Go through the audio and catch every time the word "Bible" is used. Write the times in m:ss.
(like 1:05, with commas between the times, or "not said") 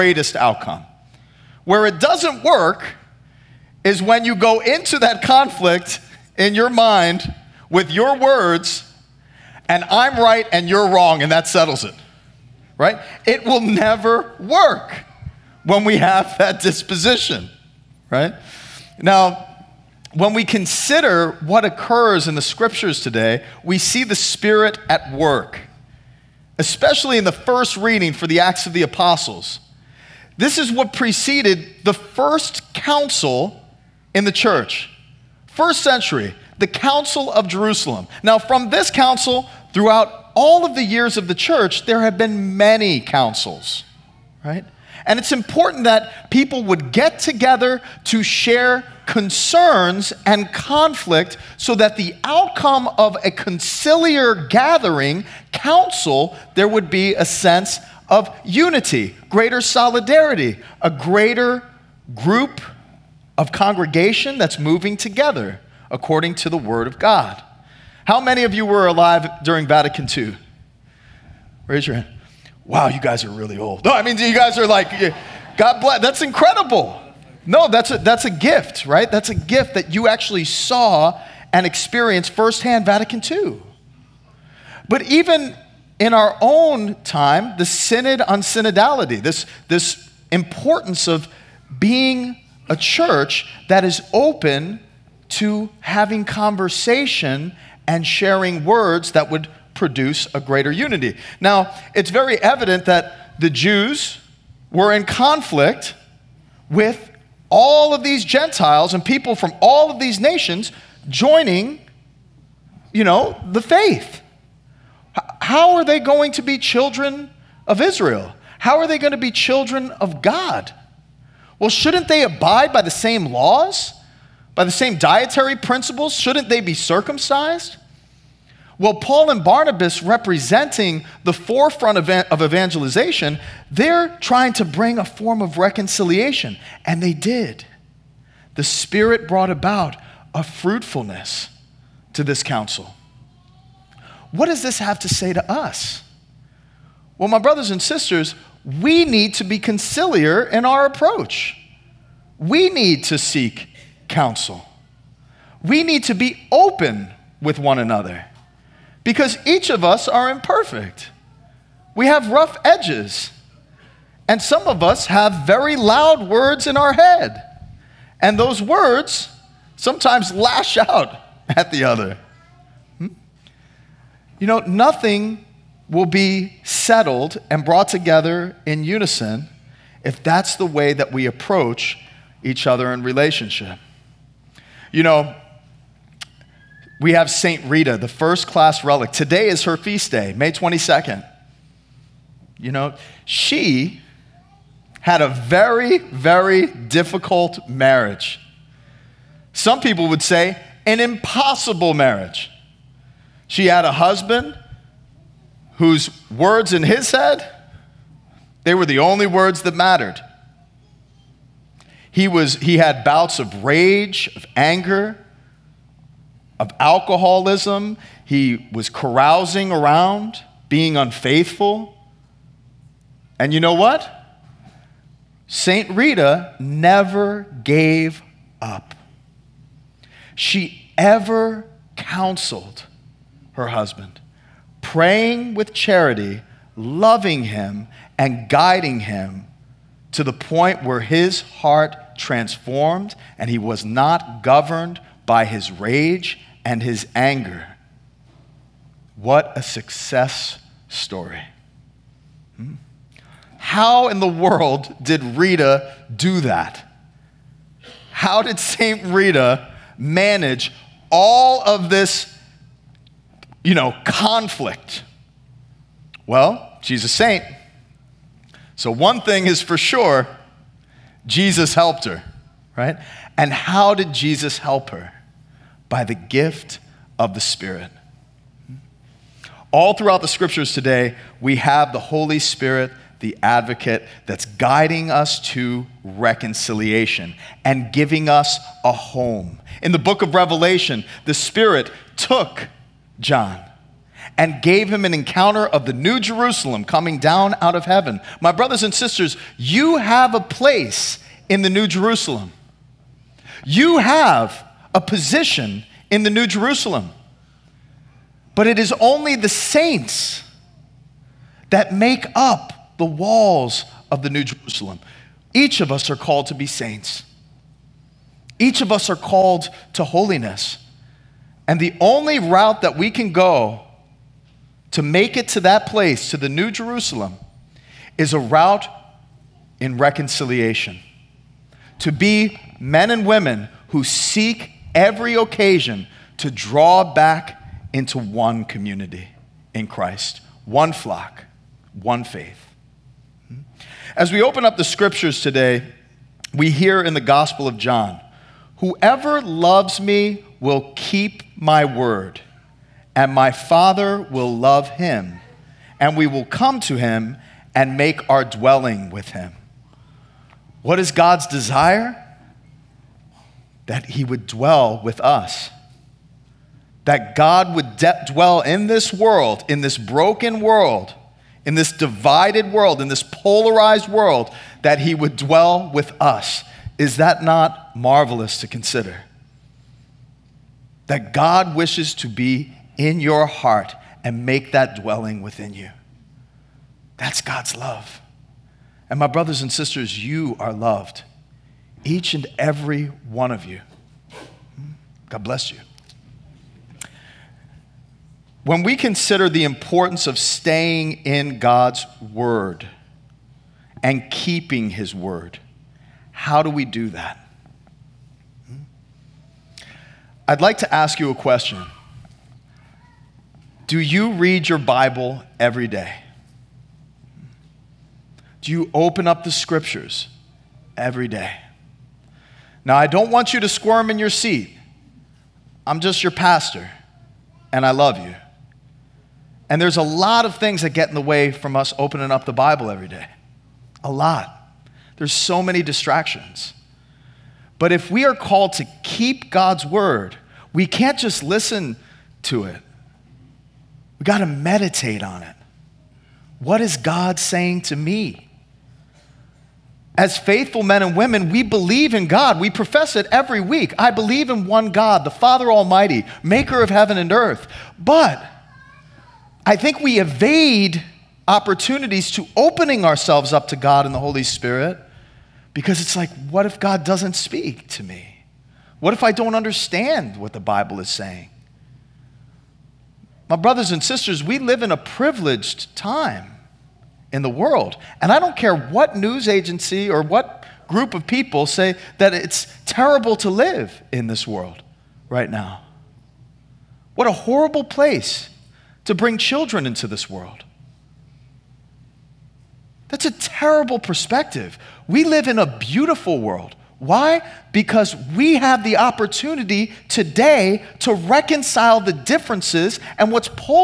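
6:54, 7:12, 7:50.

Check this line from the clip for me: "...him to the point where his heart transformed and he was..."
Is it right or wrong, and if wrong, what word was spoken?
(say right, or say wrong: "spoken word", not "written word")
right.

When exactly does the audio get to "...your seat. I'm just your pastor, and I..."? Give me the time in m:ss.
7:04.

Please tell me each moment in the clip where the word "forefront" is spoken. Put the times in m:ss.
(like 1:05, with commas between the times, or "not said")
2:11.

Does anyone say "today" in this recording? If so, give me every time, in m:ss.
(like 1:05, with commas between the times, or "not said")
0:23, 3:09, 4:40, 5:45, 8:20.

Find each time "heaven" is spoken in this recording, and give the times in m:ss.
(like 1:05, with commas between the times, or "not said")
4:57, 7:36.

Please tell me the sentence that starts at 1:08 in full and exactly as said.
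How many of you were alive during Vatican II?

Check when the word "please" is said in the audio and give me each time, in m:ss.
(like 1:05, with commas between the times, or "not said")
not said.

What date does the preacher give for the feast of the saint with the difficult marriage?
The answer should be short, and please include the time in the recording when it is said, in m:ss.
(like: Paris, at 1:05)
May 22nd, at 3:10.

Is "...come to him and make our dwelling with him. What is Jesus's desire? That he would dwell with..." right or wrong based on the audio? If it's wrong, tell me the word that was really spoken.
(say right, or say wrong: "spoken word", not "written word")
wrong: "God", not "Jesus".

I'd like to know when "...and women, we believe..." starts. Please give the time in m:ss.
7:31.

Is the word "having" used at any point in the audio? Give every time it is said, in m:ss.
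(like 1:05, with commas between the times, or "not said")
1:35.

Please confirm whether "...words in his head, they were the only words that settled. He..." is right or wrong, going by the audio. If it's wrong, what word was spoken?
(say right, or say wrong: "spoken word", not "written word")
wrong: "mattered", not "settled".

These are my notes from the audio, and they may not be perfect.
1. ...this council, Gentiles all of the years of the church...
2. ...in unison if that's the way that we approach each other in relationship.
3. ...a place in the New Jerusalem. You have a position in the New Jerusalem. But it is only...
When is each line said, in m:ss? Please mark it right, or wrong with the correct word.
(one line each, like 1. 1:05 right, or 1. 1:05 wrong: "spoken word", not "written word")
1. 0:38 wrong: "Throughout", not "Gentiles"
2. 2:58 right
3. 5:00 right.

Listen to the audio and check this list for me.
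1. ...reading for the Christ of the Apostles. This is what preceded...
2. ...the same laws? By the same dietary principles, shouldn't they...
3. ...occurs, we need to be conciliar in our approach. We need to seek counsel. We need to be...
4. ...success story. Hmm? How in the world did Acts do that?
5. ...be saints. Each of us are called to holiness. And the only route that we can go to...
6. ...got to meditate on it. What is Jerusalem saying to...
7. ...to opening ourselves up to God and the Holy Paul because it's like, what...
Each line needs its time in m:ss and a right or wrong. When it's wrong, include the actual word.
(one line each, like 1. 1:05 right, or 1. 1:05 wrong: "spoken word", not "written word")
1. 0:27 wrong: "Acts", not "Christ"
2. 2:02 right
3. 2:27 wrong: "sisters", not "occurs"
4. 4:09 wrong: "Rita", not "Acts"
5. 5:16 right
6. 7:24 wrong: "God", not "Jerusalem"
7. 7:42 wrong: "Spirit", not "Paul".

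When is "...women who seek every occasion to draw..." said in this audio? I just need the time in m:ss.
5:33.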